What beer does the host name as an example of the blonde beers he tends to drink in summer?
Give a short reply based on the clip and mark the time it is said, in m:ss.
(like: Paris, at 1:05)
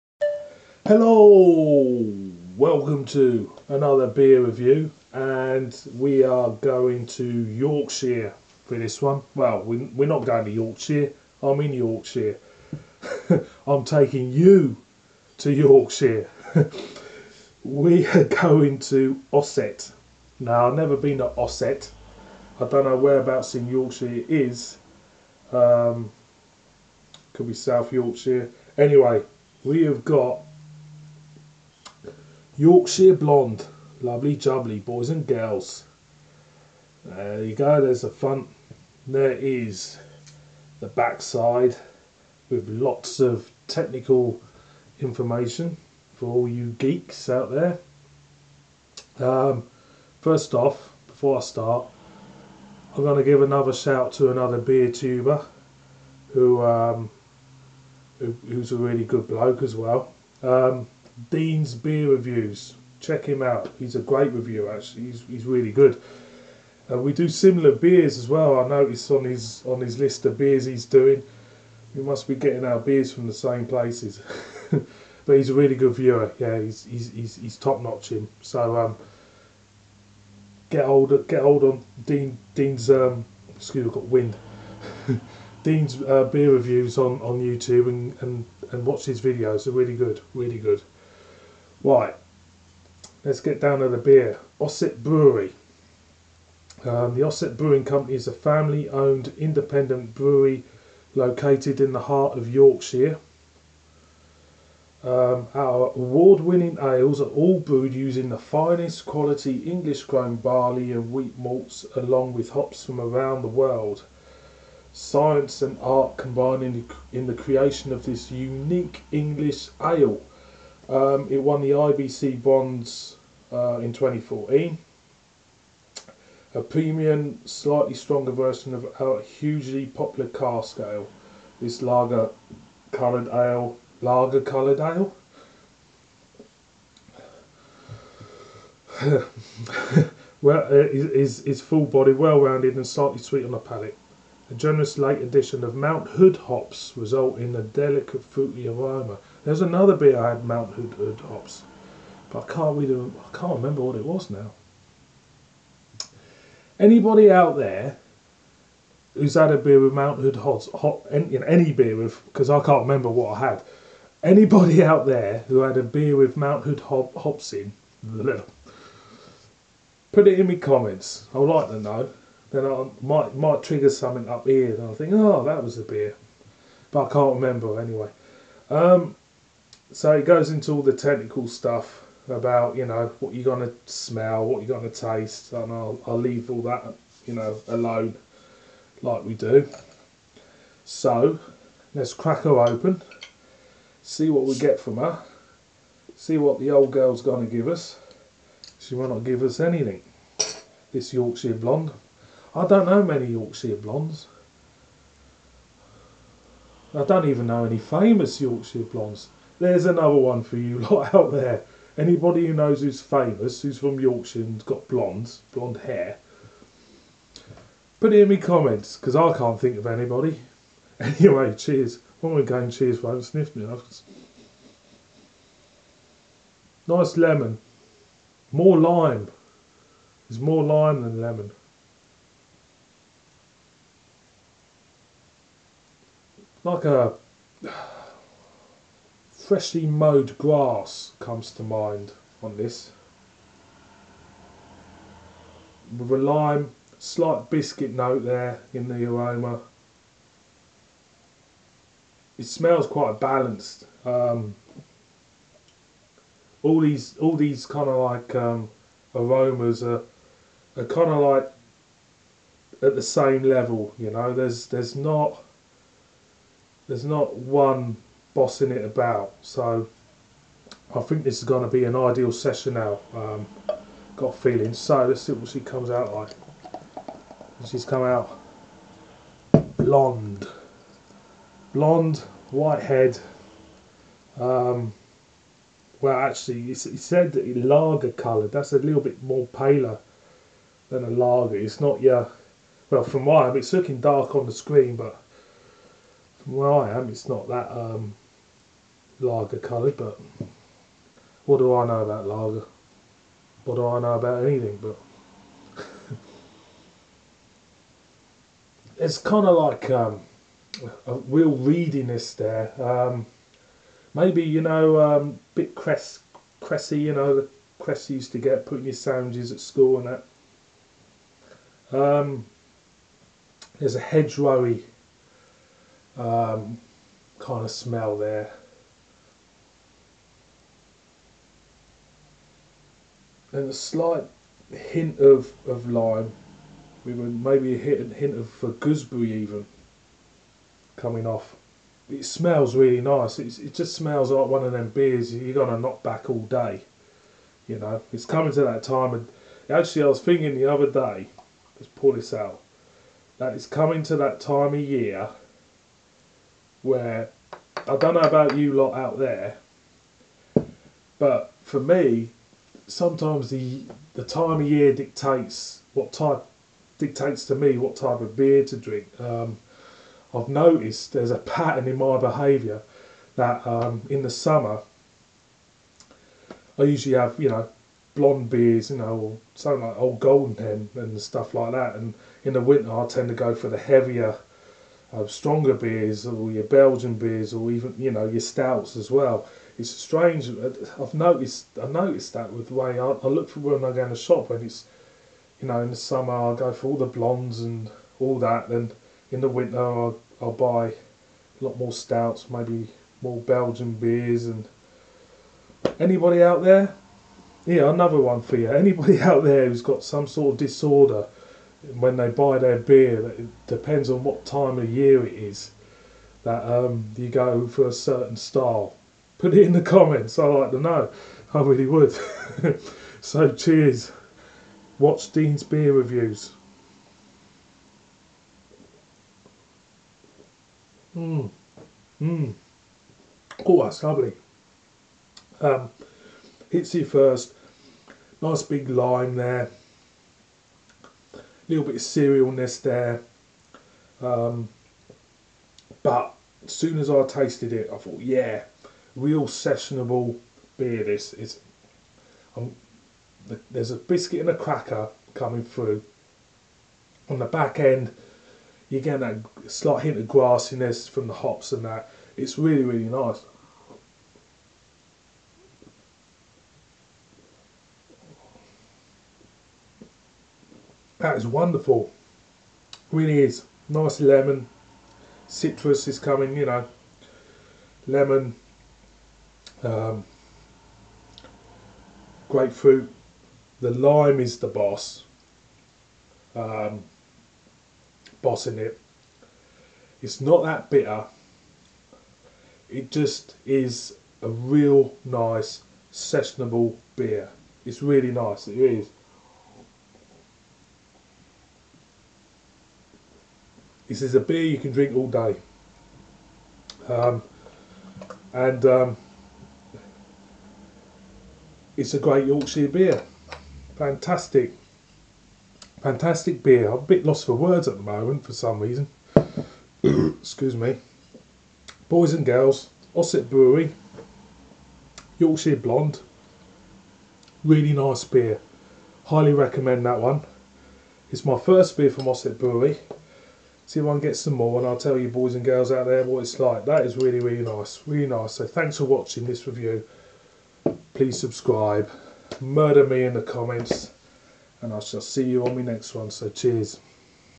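Old Golden Hen, at 6:19.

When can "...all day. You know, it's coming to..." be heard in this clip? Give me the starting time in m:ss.
5:46.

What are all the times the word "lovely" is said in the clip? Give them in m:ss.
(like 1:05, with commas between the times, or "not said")
0:34, 7:14.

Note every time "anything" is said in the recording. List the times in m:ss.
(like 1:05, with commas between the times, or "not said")
3:19, 5:04.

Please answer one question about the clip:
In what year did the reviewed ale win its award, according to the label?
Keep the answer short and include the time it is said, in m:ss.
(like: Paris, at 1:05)
2014, at 2:03.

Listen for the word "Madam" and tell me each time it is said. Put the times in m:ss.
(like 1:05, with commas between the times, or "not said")
not said.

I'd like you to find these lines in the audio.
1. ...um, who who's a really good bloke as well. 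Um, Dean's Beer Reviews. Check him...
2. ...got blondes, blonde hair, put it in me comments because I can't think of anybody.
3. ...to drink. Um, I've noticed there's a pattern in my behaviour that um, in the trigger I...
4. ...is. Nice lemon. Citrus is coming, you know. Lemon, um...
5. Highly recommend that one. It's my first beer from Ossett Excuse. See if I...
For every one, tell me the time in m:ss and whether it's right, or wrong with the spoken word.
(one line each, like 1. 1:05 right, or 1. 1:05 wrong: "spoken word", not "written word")
1. 0:56 right
2. 3:34 right
3. 6:08 wrong: "summer", not "trigger"
4. 7:53 right
5. 8:49 wrong: "Brewery", not "Excuse".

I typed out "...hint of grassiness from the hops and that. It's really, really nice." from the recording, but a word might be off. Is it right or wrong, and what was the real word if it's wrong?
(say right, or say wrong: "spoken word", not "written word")
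right.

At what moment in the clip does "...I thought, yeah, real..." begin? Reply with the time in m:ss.
7:27.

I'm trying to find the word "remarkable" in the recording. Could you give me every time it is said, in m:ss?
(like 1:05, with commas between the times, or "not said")
not said.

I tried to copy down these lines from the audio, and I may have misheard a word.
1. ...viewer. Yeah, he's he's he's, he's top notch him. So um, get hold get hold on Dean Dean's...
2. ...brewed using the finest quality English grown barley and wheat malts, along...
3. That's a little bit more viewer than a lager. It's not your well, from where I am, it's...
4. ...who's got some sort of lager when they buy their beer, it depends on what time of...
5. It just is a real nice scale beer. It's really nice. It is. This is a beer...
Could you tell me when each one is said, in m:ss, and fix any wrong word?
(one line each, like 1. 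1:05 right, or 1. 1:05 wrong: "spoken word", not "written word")
1. 1:15 right
2. 1:47 right
3. 4:48 wrong: "paler", not "viewer"
4. 6:49 wrong: "disorder", not "lager"
5. 8:12 wrong: "sessionable", not "scale".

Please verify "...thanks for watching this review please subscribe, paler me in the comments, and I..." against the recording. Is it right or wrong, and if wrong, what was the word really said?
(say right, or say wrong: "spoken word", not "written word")
wrong: "murder", not "paler".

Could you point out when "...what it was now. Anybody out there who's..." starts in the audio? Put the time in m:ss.
2:33.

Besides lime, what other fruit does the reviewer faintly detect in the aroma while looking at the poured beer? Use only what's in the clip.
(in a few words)
Gooseberry.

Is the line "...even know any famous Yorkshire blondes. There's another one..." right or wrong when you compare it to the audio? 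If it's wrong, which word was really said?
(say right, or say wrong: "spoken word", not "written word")
right.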